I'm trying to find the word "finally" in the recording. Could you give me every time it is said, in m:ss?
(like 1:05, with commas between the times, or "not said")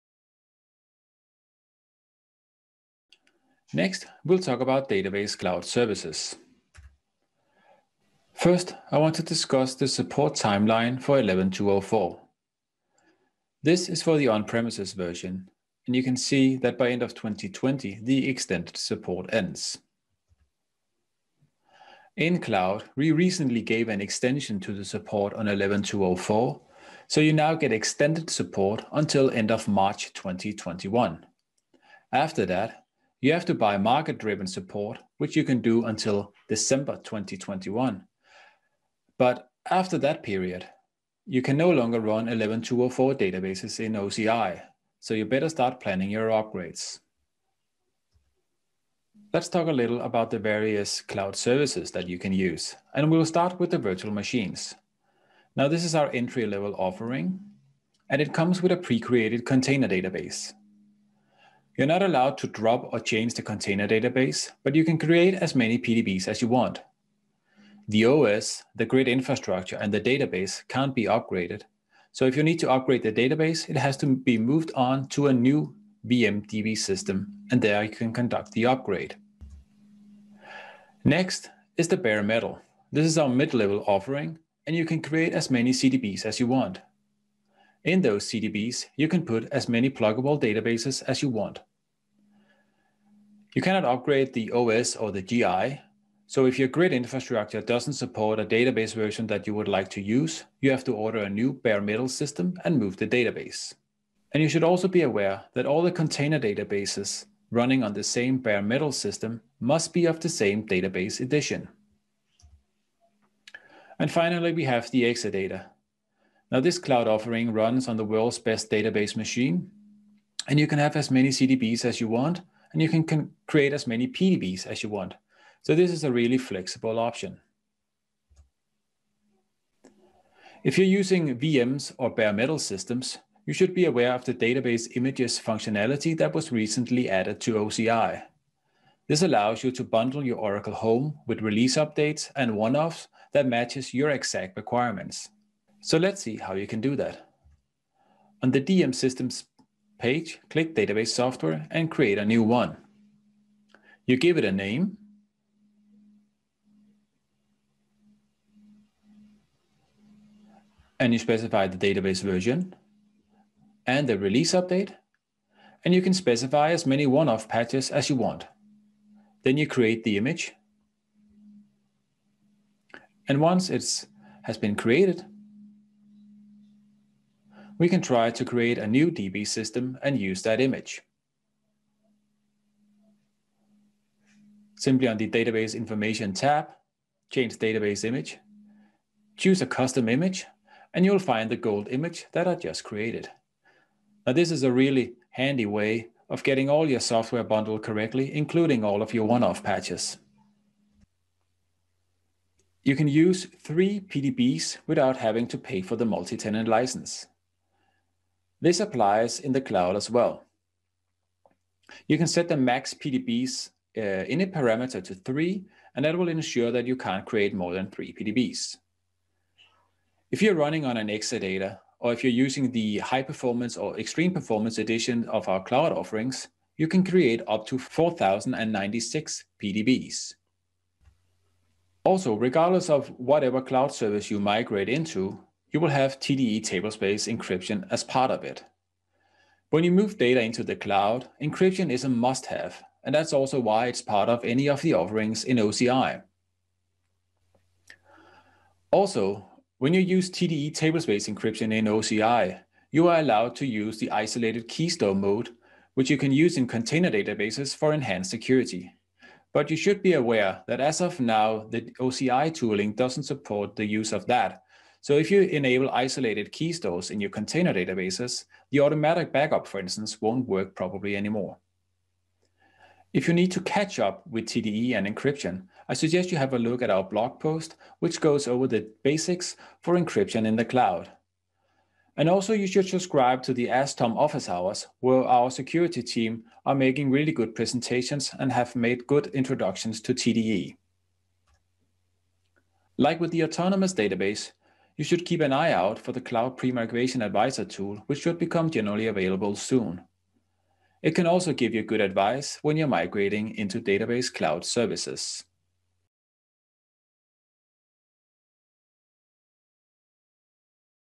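1:54.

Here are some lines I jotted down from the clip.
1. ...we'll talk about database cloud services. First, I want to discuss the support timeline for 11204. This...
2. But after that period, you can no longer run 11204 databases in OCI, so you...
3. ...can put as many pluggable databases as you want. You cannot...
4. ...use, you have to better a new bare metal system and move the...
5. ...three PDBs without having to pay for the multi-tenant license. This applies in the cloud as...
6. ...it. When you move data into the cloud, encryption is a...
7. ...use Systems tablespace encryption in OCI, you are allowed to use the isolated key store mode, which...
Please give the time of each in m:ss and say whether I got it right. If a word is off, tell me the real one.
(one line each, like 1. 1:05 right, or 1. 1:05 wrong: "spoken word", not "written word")
1. 0:04 right
2. 0:39 right
3. 1:29 right
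4. 1:40 wrong: "order", not "better"
5. 3:23 right
6. 3:58 right
7. 4:10 wrong: "TDE", not "Systems".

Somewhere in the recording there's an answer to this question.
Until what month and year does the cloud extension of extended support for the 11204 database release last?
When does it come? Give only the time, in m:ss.
0:29.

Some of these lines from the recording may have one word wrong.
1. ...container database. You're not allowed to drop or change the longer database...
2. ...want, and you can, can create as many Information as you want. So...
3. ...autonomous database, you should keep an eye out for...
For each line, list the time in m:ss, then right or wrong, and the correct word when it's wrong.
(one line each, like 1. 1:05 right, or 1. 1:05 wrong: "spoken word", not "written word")
1. 0:59 wrong: "container", not "longer"
2. 2:02 wrong: "PDBs", not "Information"
3. 4:53 right.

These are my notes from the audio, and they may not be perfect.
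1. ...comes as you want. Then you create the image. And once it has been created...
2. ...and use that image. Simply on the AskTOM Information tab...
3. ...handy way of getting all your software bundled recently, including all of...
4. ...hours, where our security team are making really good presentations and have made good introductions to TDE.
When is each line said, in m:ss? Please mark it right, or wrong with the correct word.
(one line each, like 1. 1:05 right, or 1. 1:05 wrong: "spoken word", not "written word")
1. 2:47 wrong: "patches", not "comes"
2. 3:00 wrong: "Database", not "AskTOM"
3. 3:15 wrong: "correctly", not "recently"
4. 4:44 right.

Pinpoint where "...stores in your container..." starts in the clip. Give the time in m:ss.
4:26.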